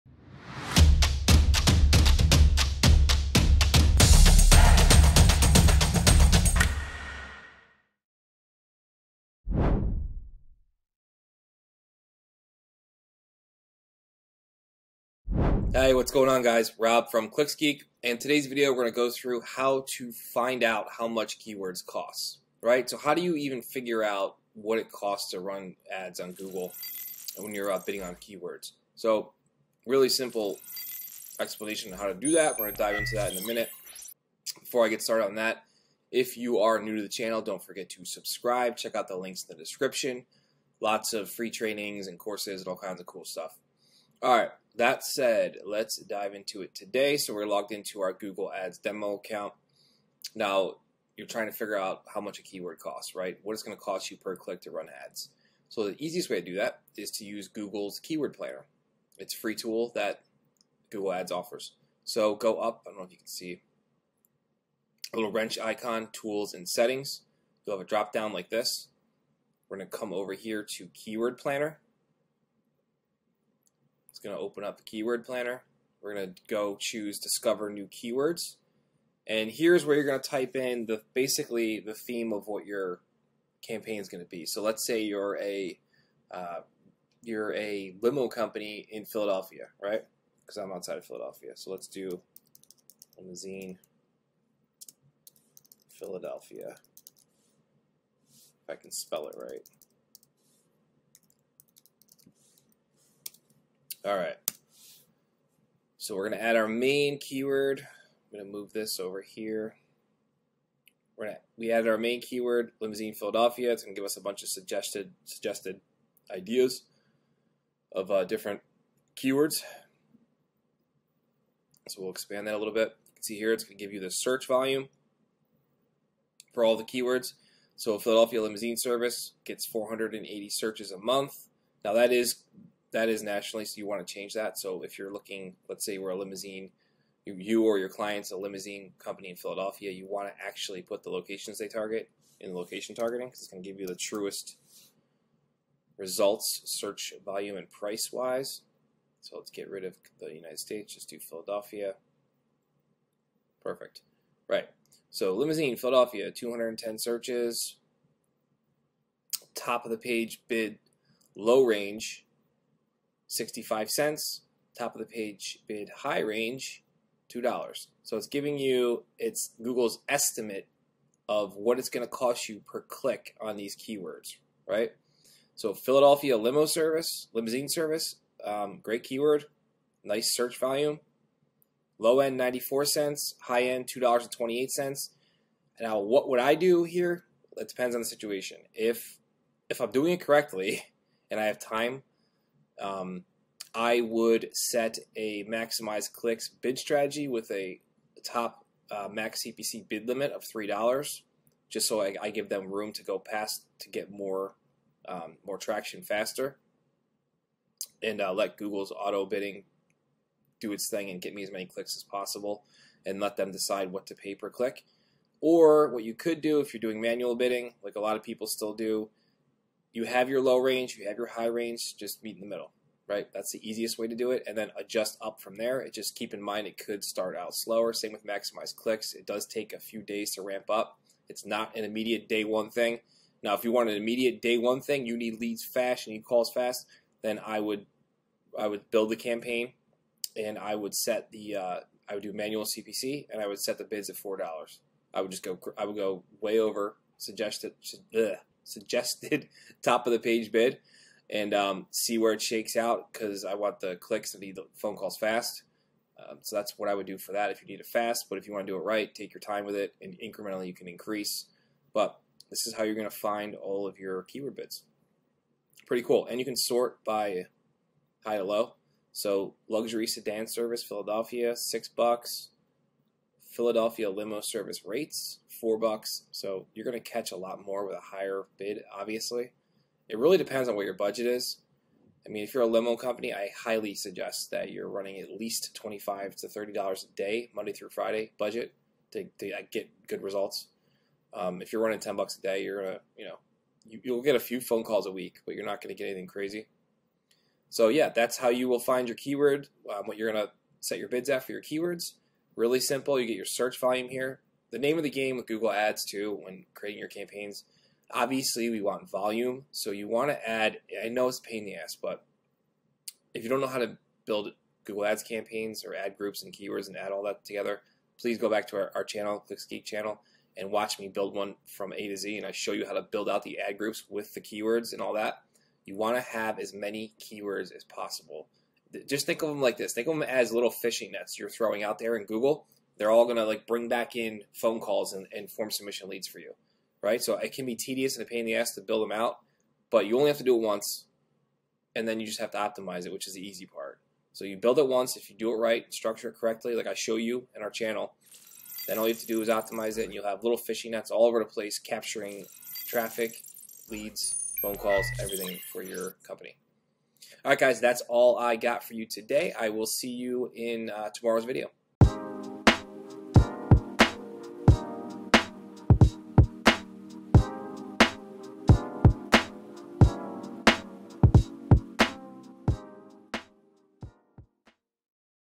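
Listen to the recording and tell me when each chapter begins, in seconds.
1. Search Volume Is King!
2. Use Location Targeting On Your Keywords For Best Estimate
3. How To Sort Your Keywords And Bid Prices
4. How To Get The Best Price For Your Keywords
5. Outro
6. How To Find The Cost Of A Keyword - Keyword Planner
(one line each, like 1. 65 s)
1. 310 s
2. 140 s
3. 268 s
4. 186 s
5. 360 s
6. 45 s.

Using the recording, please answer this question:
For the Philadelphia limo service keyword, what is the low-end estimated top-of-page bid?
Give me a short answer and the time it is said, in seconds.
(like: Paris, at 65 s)
94 cents, at 182 s.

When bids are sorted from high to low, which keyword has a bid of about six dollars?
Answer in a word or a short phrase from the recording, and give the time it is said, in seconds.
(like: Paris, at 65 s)
luxury sedan service Philadelphia, at 269 s.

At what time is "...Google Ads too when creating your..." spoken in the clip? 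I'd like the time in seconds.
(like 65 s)
305 s.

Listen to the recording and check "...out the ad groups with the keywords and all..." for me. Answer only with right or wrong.
right.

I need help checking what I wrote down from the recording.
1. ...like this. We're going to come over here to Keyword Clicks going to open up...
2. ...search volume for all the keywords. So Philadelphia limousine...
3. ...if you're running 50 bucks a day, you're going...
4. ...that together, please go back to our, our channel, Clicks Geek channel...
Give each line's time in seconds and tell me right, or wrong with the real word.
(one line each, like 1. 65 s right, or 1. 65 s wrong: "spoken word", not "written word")
1. 68 s wrong: "Planner", not "Clicks"
2. 124 s right
3. 291 s wrong: "10", not "50"
4. 317 s right.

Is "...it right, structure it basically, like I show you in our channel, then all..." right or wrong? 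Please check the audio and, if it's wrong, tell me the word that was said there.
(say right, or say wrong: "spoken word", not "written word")
wrong: "correctly", not "basically".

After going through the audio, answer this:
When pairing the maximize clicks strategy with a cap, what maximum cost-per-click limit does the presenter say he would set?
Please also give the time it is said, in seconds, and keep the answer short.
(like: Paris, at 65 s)
$3, at 200 s.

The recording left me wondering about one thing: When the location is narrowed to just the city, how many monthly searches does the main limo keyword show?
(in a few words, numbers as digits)
210.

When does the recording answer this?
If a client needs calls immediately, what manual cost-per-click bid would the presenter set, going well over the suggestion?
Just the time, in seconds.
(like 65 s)
244 s.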